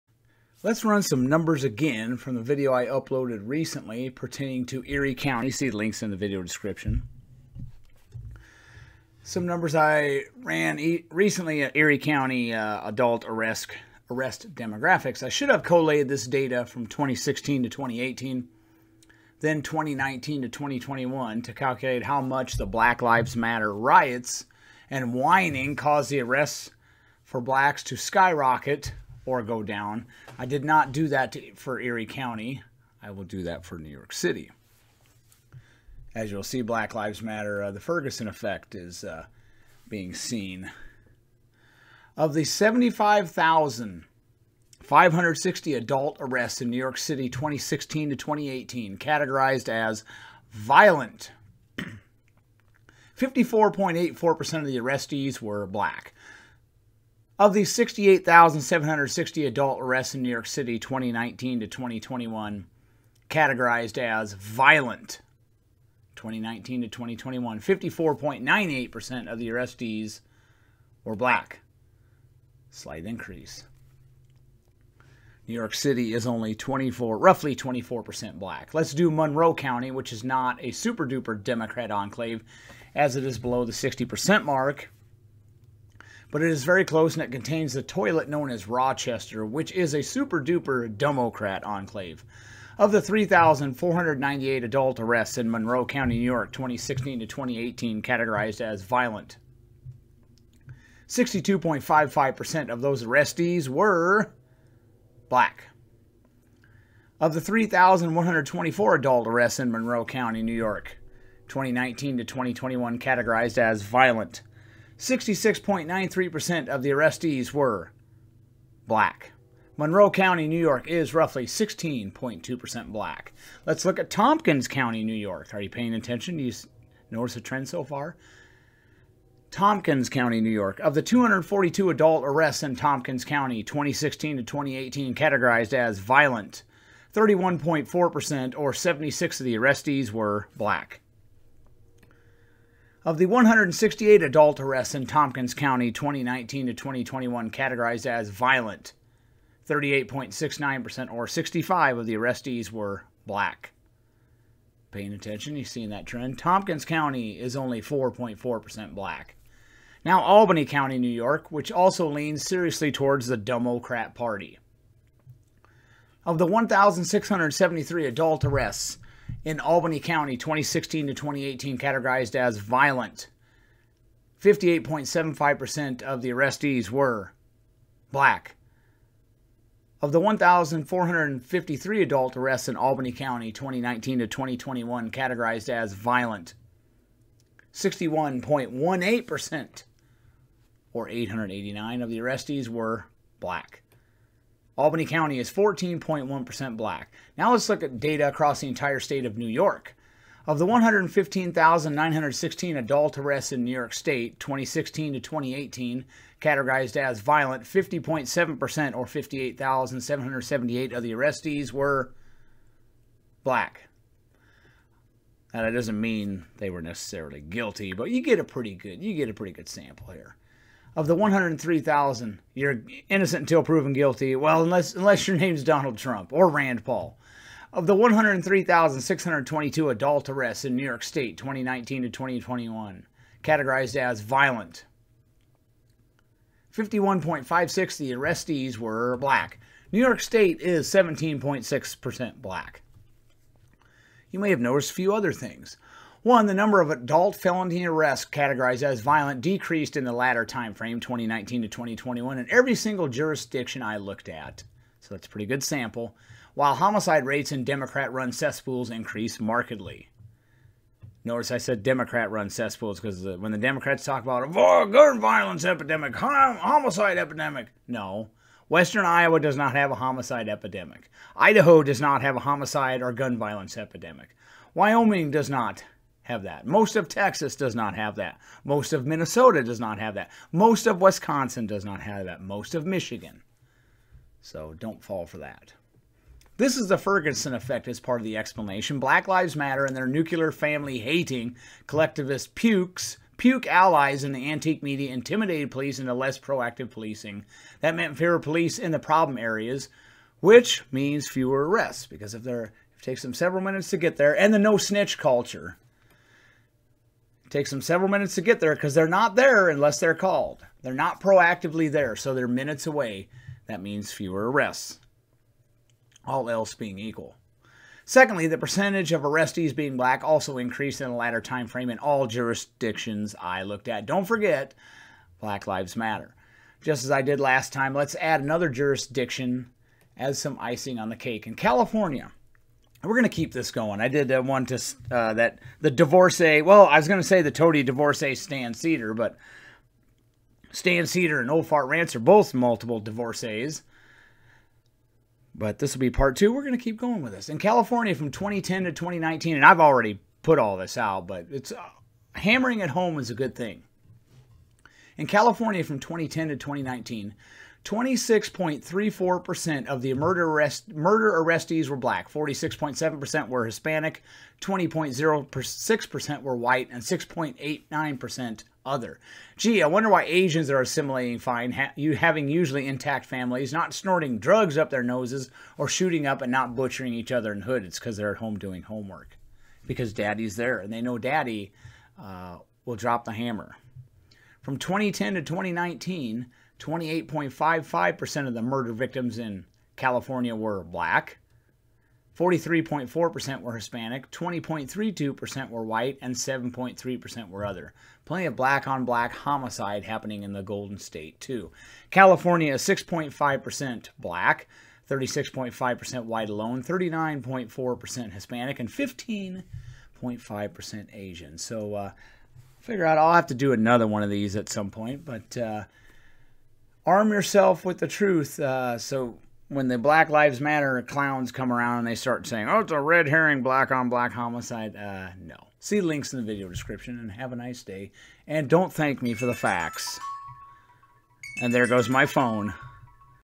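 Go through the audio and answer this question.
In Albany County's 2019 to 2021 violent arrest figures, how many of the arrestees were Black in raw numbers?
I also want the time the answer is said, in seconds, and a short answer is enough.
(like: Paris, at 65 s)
889, at 191 s.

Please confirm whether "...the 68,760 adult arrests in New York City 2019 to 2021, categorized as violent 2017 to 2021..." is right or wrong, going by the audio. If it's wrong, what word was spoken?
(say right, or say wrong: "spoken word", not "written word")
wrong: "2019", not "2017".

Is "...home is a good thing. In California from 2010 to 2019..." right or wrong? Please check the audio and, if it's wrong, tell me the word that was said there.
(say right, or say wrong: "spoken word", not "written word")
right.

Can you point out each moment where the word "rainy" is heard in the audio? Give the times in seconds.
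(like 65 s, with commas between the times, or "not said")
not said.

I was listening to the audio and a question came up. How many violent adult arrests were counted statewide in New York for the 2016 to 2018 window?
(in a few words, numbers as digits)
115,916.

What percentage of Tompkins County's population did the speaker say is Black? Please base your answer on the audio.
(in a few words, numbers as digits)
4.4%.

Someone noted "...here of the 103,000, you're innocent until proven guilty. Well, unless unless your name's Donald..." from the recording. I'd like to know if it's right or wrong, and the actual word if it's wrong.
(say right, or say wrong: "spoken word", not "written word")
right.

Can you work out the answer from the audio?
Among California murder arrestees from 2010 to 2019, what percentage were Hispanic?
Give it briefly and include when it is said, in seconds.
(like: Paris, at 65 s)
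46.7%, at 362 s.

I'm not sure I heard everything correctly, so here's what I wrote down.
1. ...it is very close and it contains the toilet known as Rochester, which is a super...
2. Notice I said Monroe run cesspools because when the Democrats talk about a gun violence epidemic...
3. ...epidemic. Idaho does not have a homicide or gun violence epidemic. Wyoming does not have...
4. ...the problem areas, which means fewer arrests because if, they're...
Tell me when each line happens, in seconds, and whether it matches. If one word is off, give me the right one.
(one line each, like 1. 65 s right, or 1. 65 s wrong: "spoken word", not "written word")
1. 86 s right
2. 261 s wrong: "Democrat", not "Monroe"
3. 270 s right
4. 298 s right.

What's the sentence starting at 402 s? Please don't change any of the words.
California is 6.5% black, 36.5% white alone, 39.4% Hispanic, and 15.5% Asian.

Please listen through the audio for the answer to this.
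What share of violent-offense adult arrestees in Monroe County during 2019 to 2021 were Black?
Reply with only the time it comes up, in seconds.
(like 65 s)
115 s.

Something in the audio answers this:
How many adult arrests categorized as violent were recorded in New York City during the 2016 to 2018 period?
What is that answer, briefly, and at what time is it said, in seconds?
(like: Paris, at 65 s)
75,560, at 42 s.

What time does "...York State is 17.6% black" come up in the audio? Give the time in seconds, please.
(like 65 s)
239 s.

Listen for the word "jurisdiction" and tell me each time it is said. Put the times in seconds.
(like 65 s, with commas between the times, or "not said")
253 s, 322 s, 328 s.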